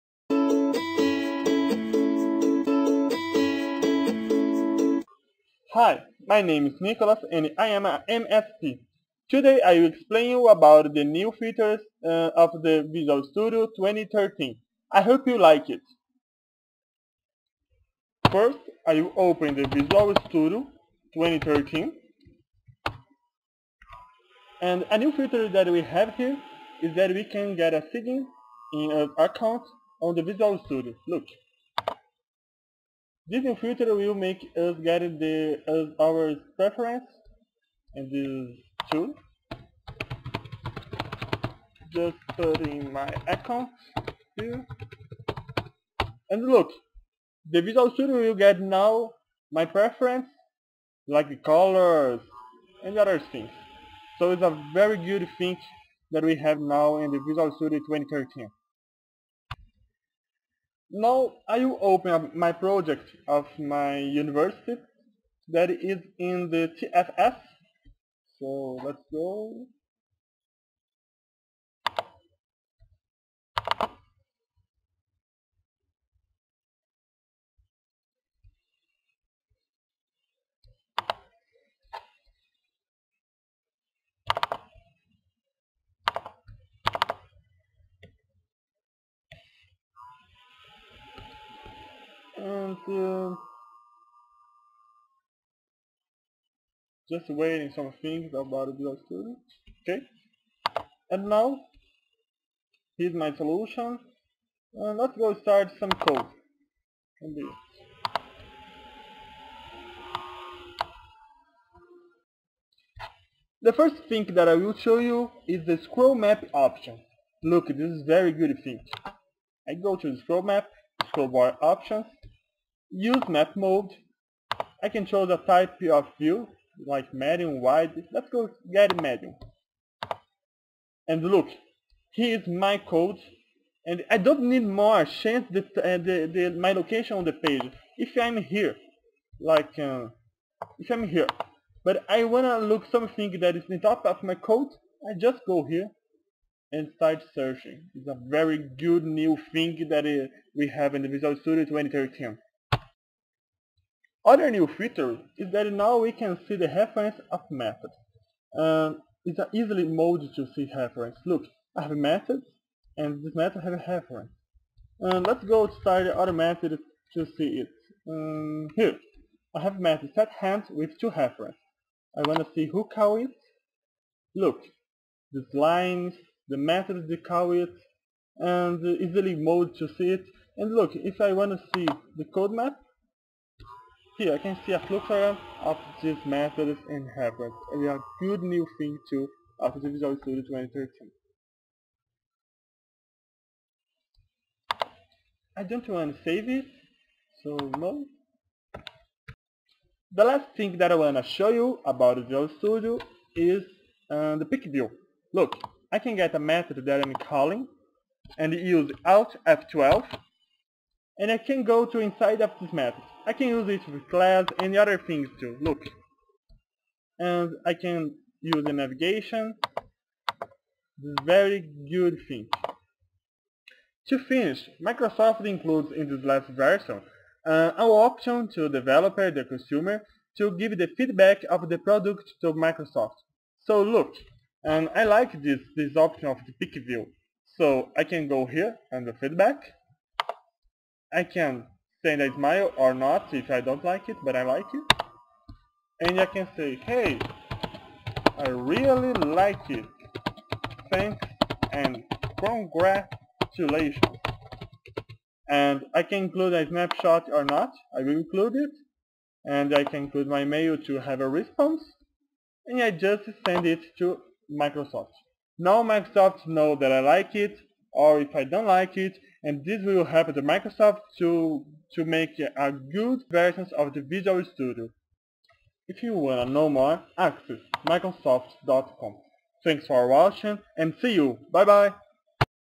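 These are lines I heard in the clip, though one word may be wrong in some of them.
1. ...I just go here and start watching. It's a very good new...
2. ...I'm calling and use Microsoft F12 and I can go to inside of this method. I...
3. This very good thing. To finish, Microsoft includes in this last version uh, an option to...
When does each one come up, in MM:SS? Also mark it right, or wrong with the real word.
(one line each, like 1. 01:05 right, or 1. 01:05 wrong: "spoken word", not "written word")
1. 02:25 wrong: "searching", not "watching"
2. 03:27 wrong: "Alt", not "Microsoft"
3. 03:40 right.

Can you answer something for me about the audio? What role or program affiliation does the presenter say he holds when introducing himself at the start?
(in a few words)
MSP.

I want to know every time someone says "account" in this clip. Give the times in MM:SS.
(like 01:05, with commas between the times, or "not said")
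00:29, 00:43.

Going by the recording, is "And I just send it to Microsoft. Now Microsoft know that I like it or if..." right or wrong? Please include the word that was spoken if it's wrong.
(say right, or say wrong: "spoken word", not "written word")
right.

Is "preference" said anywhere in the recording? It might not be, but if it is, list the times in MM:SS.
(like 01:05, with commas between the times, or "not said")
00:36, 00:49.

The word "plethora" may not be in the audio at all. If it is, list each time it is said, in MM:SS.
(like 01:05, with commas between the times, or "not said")
03:04.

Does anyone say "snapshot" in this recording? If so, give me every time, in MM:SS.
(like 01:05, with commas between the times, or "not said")
04:16.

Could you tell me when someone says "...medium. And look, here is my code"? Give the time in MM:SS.
02:09.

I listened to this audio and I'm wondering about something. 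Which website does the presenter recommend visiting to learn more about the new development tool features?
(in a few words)
microsoft.com.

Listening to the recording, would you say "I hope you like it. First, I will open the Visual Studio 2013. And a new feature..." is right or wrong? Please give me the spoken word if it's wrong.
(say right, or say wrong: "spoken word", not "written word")
right.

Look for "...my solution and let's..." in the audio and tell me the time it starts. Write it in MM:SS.
01:43.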